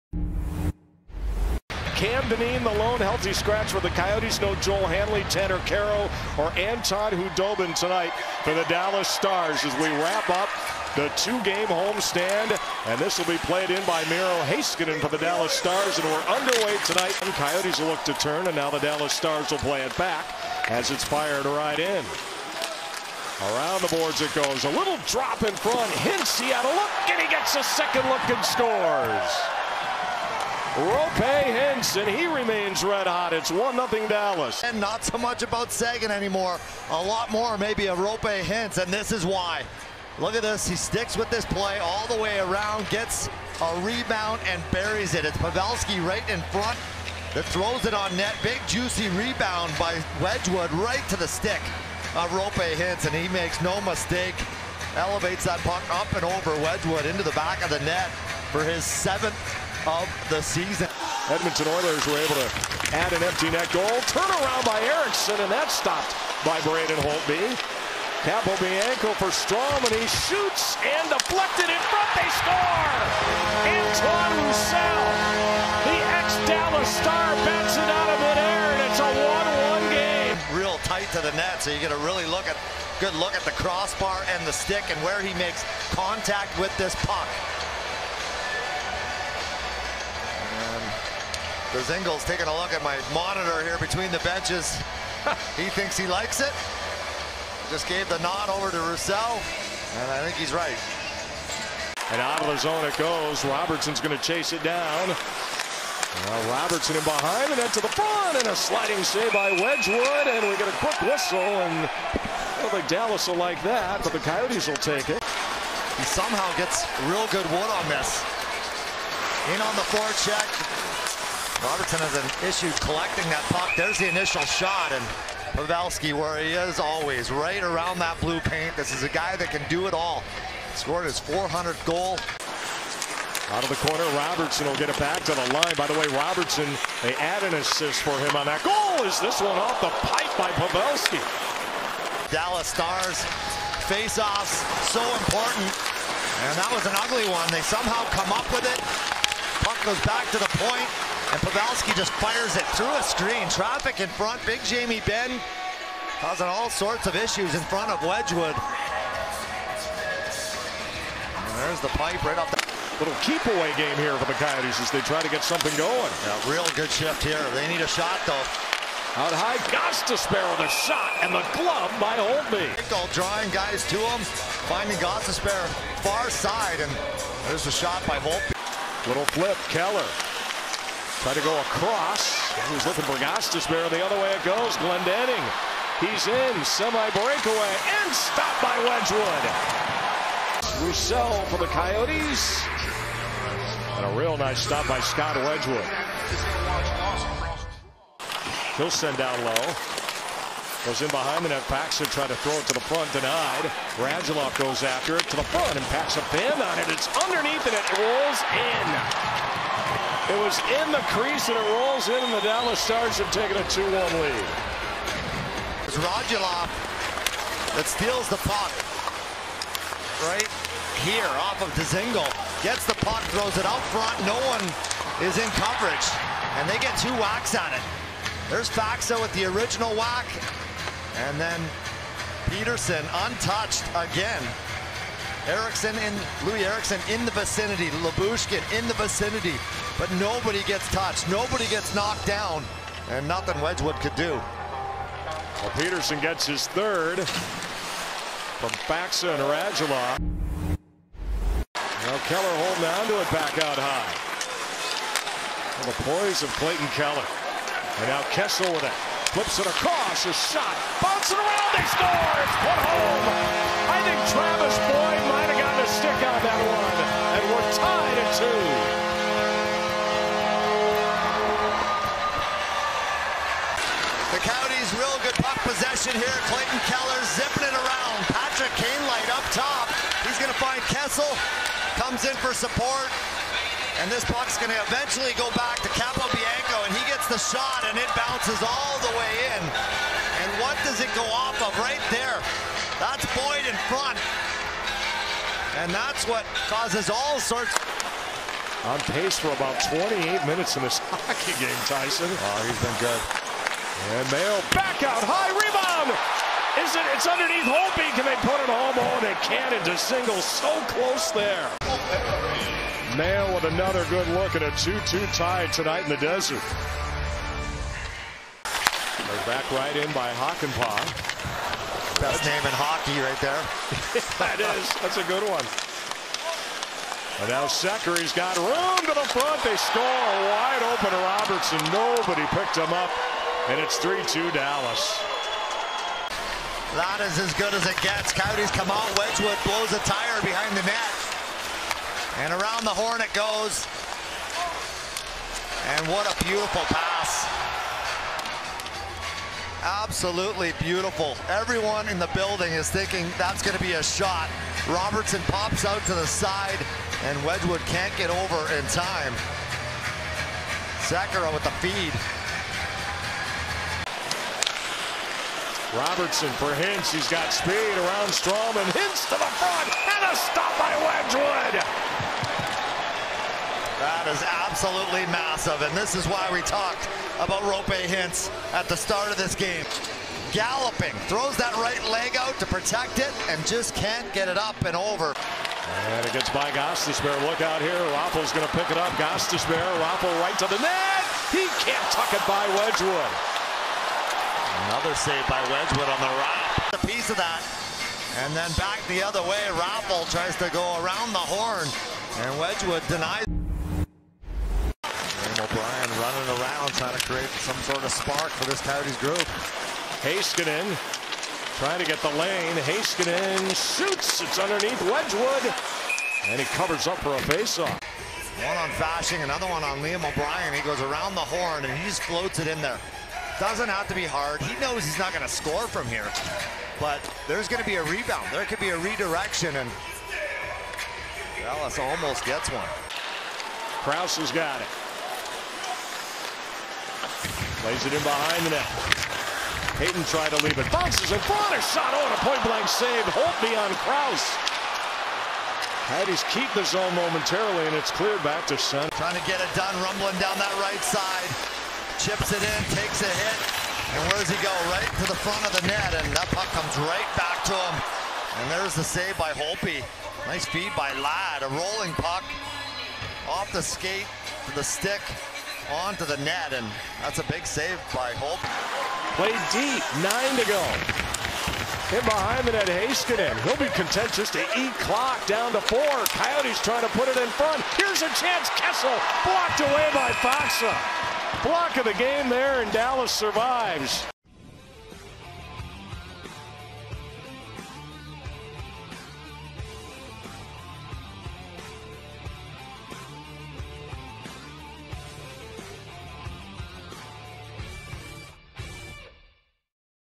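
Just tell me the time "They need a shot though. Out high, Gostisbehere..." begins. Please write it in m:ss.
2:47.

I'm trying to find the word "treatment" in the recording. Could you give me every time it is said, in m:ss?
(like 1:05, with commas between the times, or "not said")
not said.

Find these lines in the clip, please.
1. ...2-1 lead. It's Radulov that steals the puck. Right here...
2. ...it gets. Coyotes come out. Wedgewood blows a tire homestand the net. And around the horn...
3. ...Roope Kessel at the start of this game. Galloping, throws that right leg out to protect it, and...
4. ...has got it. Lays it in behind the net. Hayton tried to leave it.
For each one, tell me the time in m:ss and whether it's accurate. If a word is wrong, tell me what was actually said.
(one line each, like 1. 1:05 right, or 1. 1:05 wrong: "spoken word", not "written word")
1. 3:33 right
2. 5:37 wrong: "behind", not "homestand"
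3. 6:17 wrong: "Hintz", not "Kessel"
4. 7:14 right.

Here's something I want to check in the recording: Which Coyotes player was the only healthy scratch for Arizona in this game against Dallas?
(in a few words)
Cam Dineen.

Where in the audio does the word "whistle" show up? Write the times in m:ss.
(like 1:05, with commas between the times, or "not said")
1:51.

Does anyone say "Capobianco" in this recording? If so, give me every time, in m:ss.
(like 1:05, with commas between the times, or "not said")
1:08, 4:45.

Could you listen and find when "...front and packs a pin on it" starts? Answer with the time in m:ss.
3:25.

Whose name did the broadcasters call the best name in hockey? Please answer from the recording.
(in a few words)
Hakanpää.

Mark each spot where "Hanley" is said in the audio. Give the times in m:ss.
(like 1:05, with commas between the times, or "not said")
0:04.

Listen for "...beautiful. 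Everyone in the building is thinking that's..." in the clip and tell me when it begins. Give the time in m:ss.
5:50.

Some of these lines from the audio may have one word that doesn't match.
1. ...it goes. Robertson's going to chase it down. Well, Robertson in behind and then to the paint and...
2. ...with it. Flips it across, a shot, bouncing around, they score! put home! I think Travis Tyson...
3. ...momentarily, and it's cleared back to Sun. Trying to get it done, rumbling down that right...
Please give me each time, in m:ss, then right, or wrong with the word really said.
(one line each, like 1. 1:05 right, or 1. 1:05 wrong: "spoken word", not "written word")
1. 1:42 wrong: "front", not "paint"
2. 4:18 wrong: "Boyd", not "Tyson"
3. 7:27 right.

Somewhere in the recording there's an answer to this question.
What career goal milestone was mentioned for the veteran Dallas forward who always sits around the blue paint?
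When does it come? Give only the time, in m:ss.
2:11.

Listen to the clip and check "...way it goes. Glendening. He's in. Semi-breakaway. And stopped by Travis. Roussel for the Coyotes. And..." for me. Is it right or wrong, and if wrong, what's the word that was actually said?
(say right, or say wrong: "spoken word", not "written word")
wrong: "Wedgewood", not "Travis".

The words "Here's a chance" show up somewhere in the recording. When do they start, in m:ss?
7:57.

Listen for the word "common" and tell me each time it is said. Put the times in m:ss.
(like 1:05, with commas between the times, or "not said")
not said.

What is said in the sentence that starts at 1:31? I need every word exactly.
Dzingel's taking a look at my monitor here between the benches.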